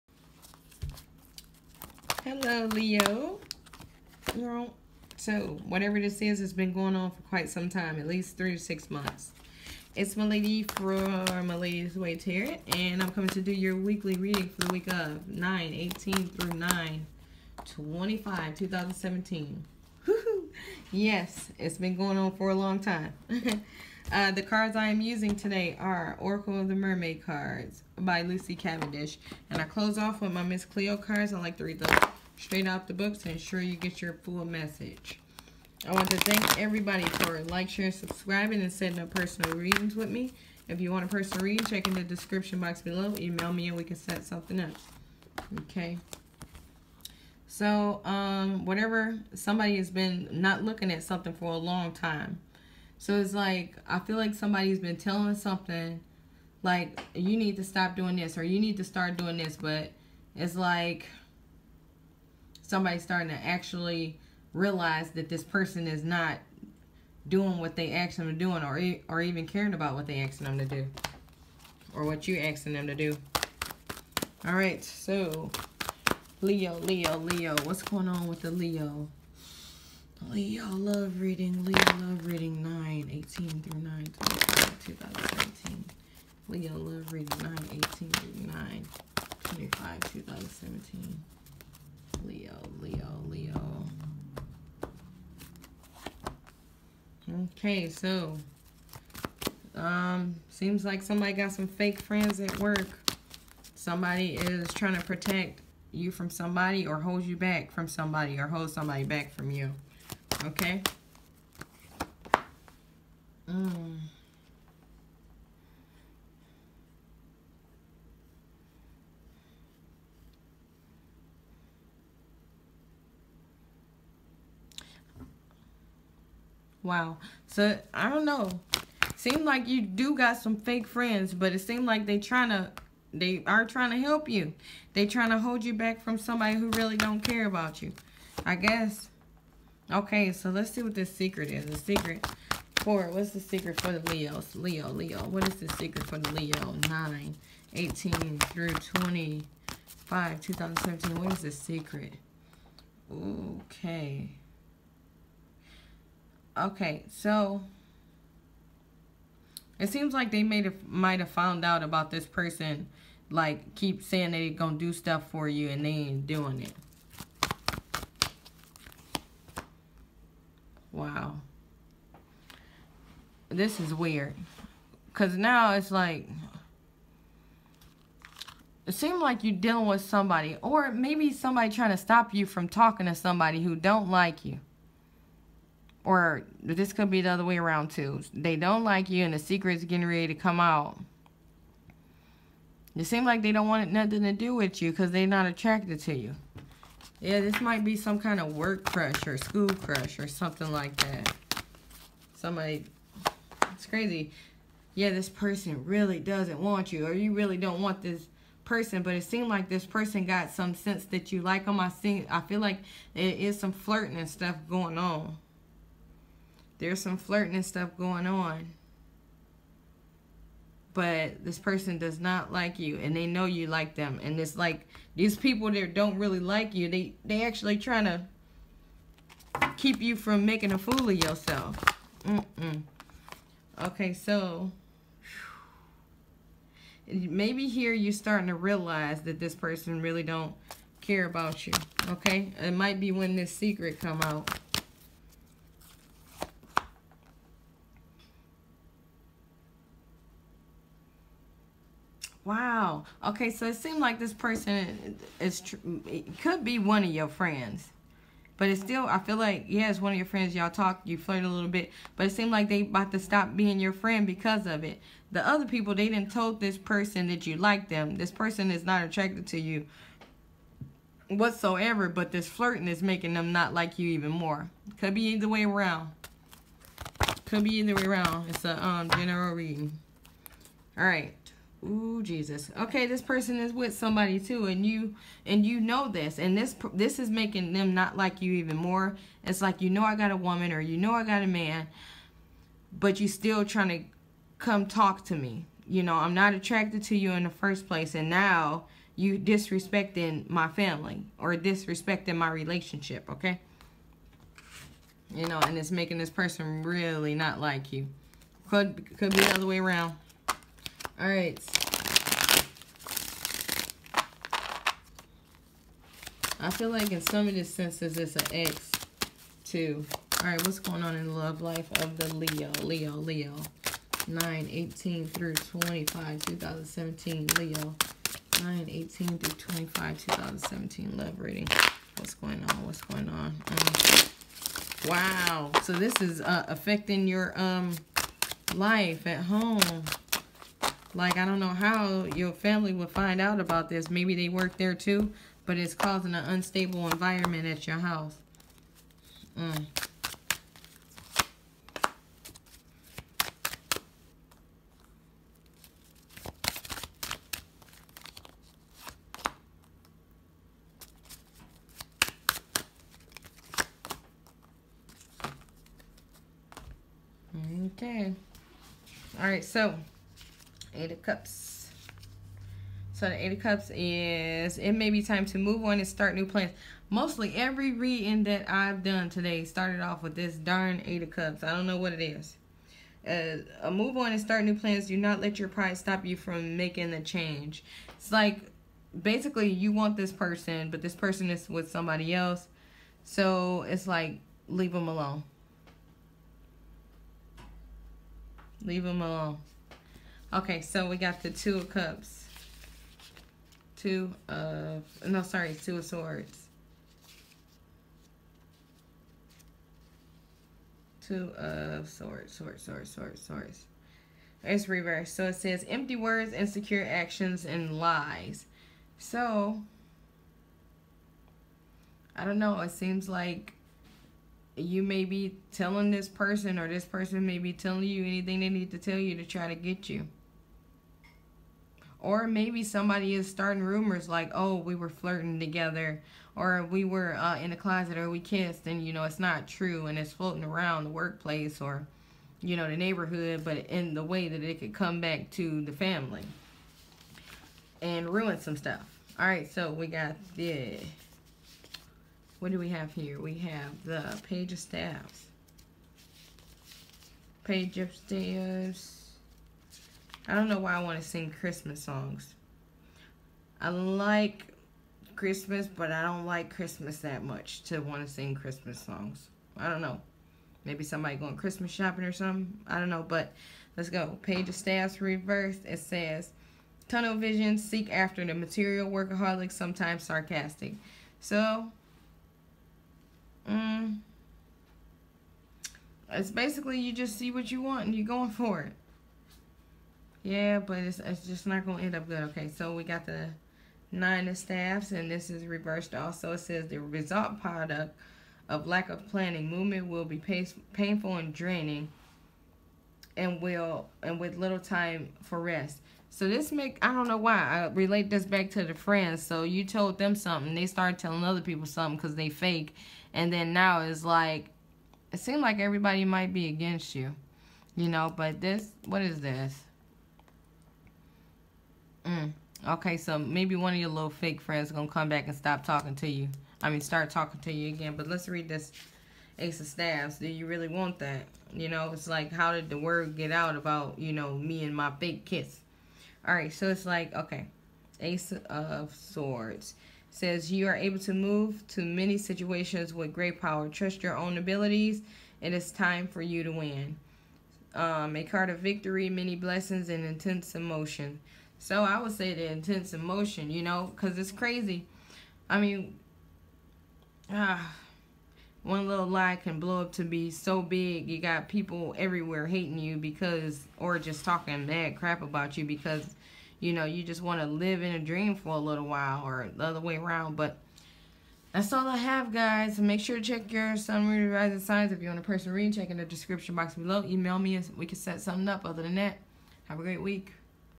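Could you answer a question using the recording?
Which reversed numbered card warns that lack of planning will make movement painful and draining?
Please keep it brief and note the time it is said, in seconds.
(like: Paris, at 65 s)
Nine of Staffs, at 494 s.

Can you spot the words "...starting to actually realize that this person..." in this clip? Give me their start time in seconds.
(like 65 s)
63 s.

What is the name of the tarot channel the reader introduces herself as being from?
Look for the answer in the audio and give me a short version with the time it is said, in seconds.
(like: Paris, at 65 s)
Lady's Way Tarot, at 11 s.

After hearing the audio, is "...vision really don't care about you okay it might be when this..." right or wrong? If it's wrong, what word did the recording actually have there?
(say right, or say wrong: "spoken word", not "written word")
wrong: "person", not "vision".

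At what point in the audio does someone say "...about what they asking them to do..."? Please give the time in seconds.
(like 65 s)
69 s.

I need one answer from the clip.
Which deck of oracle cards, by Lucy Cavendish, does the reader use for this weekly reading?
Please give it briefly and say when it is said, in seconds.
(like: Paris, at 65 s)
Oracle of the Mermaid, at 26 s.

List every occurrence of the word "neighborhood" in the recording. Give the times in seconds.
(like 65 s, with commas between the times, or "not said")
442 s.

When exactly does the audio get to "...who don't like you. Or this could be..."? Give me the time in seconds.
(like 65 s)
183 s.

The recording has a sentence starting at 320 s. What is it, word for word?
All right, what's going on in the love life of the Leo?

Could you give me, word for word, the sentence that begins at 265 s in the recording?
The other people, they didn't told this person that you like them.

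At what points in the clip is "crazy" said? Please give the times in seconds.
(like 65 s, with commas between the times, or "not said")
203 s, 554 s.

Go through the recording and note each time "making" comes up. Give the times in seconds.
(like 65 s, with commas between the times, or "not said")
230 s, 273 s, 287 s, 305 s, 386 s.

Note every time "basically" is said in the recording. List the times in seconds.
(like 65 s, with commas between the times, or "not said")
389 s, 486 s.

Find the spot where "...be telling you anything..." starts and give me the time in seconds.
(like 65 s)
427 s.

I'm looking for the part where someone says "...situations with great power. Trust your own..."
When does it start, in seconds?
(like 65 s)
542 s.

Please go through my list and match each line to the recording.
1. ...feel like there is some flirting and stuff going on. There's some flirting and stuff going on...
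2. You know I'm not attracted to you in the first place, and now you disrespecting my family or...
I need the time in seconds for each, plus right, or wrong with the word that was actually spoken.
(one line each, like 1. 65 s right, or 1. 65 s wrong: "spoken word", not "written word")
1. 212 s right
2. 295 s right.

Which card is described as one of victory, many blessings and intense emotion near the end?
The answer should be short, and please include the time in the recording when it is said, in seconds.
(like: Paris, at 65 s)
Ace of Swords, at 538 s.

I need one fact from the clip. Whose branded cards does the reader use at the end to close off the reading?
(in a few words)
Miss Cleo.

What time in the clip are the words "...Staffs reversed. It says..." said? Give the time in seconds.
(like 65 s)
474 s.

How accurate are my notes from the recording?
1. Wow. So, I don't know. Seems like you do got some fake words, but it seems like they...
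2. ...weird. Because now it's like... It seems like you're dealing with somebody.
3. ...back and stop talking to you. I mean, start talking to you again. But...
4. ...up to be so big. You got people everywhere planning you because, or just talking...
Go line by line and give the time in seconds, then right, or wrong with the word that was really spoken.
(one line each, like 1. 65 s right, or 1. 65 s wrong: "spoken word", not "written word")
1. 126 s wrong: "friends", not "words"
2. 173 s right
3. 525 s right
4. 560 s wrong: "hating", not "planning".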